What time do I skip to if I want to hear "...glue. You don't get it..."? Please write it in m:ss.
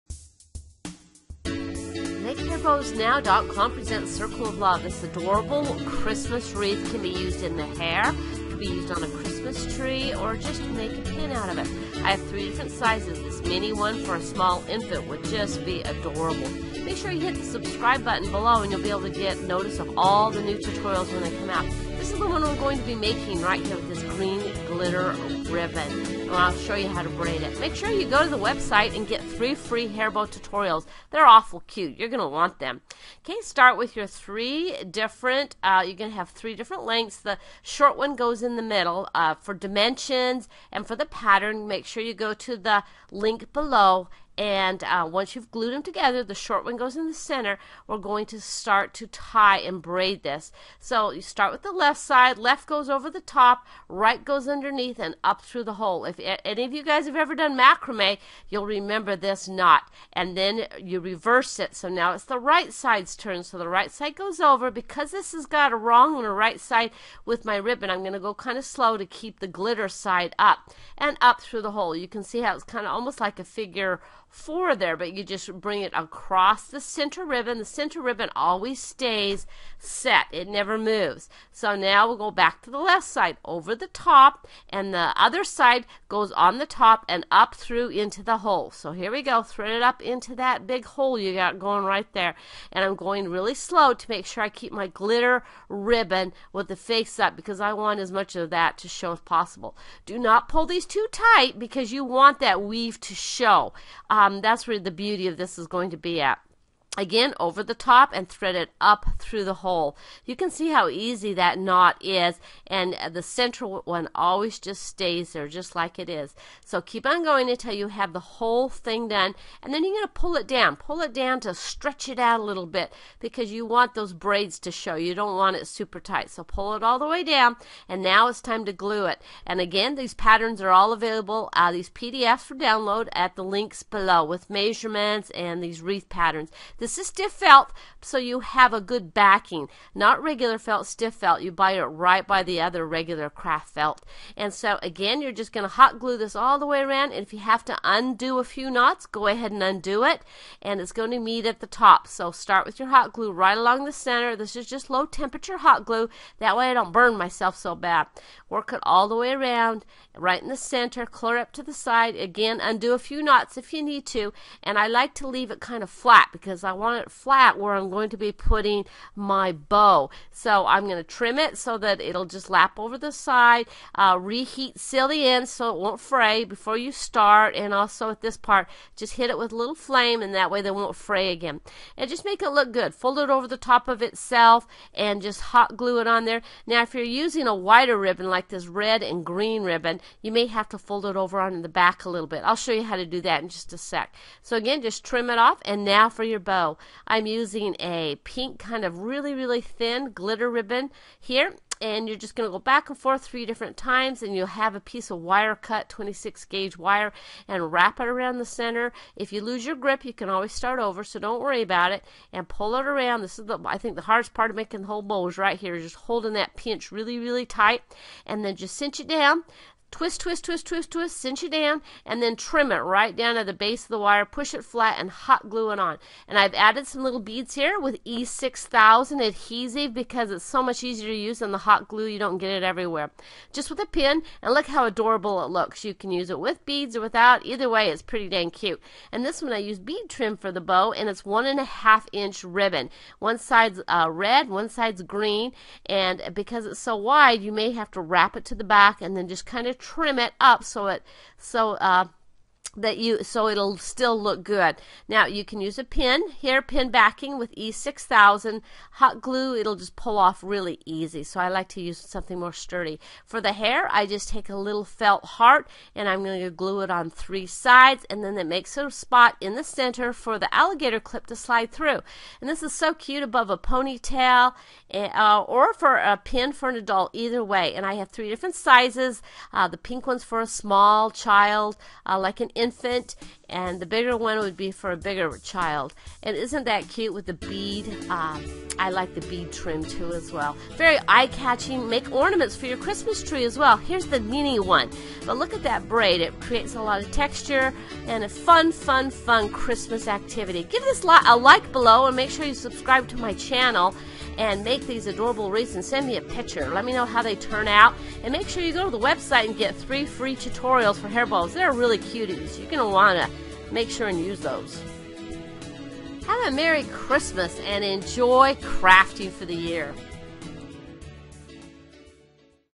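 3:51.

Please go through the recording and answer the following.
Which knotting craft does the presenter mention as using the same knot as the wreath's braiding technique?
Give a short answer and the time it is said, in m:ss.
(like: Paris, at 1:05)
Macrame, at 0:57.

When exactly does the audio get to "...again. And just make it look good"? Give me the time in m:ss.
3:01.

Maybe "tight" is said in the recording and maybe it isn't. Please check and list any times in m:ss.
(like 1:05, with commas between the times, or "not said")
1:41, 2:06, 3:37.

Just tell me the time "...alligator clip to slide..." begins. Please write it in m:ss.
4:30.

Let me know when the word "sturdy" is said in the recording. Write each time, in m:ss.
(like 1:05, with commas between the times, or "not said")
4:22.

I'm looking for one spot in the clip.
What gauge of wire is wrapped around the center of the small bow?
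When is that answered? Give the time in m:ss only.
3:25.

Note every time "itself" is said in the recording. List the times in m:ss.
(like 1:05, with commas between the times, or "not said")
3:04.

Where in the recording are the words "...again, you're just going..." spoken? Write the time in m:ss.
2:24.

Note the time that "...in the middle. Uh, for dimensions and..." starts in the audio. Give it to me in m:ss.
0:38.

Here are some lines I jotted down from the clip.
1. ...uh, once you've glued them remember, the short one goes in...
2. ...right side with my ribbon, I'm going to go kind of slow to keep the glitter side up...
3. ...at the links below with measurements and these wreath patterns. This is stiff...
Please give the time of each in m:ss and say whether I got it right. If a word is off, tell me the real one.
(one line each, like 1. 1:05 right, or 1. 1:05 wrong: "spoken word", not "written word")
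1. 0:44 wrong: "together", not "remember"
2. 1:06 right
3. 2:13 right.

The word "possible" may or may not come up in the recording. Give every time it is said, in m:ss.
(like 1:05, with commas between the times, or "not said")
1:39.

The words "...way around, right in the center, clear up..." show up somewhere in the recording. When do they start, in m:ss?
2:39.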